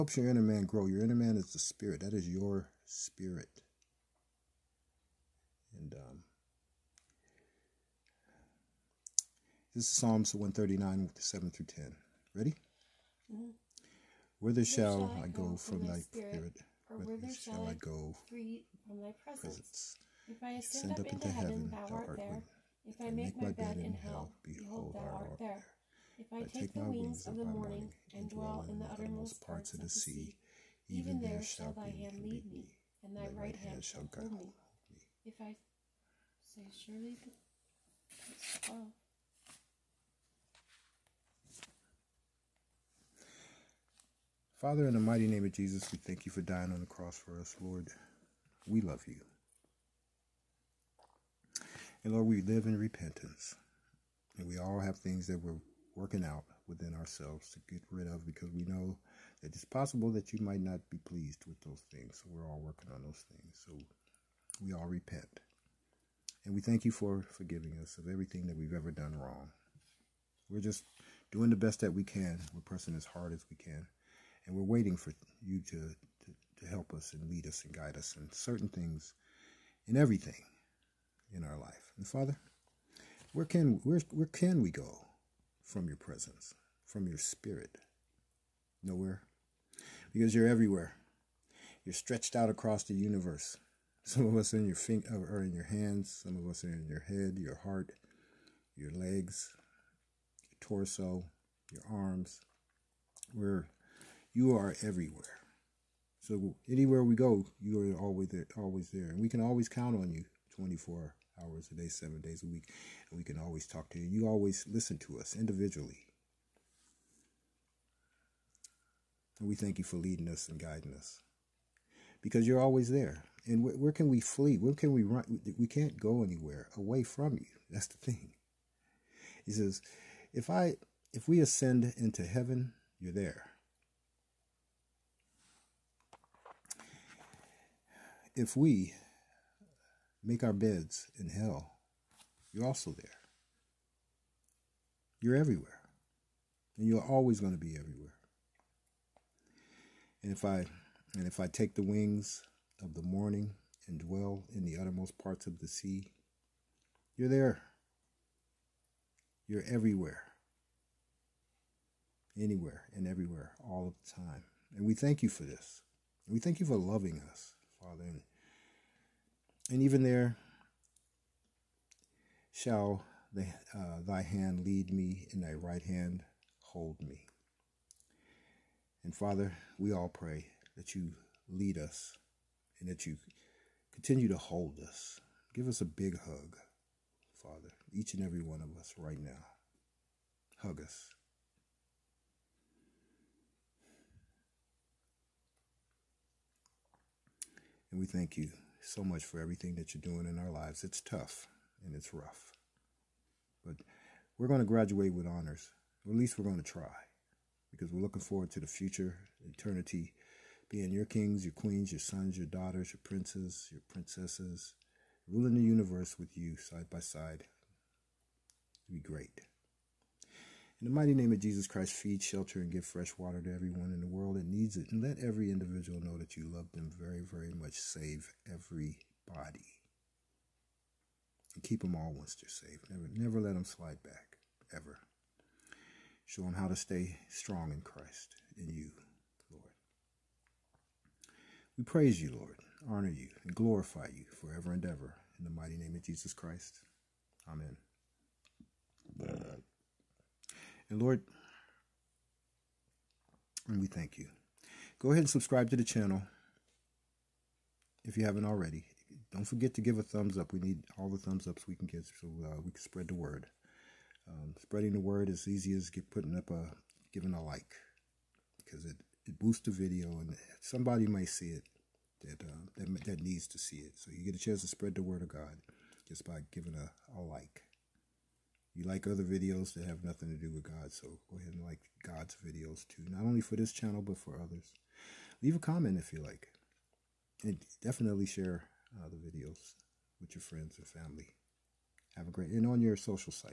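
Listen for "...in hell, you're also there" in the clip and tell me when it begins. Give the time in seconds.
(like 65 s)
141 s.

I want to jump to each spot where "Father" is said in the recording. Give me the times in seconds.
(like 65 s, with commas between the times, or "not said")
44 s, 82 s, 167 s, 179 s, 187 s.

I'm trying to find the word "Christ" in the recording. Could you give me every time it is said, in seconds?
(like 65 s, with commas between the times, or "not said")
221 s, 237 s, 246 s.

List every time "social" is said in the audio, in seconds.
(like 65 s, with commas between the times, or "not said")
292 s.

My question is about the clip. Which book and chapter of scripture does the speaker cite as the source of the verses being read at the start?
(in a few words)
Psalms 139.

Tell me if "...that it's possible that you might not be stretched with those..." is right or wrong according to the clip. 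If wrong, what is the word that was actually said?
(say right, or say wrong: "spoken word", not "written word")
wrong: "pleased", not "stretched".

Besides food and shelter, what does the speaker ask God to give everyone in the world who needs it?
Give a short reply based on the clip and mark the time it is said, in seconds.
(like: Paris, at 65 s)
fresh water, at 222 s.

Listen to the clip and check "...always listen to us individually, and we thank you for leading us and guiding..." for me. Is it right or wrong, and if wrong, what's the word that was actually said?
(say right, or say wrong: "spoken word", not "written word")
right.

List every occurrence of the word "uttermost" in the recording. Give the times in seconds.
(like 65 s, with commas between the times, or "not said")
28 s, 154 s.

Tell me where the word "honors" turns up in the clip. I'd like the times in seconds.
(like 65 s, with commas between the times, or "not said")
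205 s, 242 s.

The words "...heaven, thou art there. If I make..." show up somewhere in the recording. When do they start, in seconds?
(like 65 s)
21 s.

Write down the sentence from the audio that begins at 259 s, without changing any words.
Don't forget to give a thumbs up.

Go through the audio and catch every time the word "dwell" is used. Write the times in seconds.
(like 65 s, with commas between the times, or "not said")
28 s, 153 s.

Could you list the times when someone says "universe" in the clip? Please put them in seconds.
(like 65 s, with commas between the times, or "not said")
92 s, 215 s.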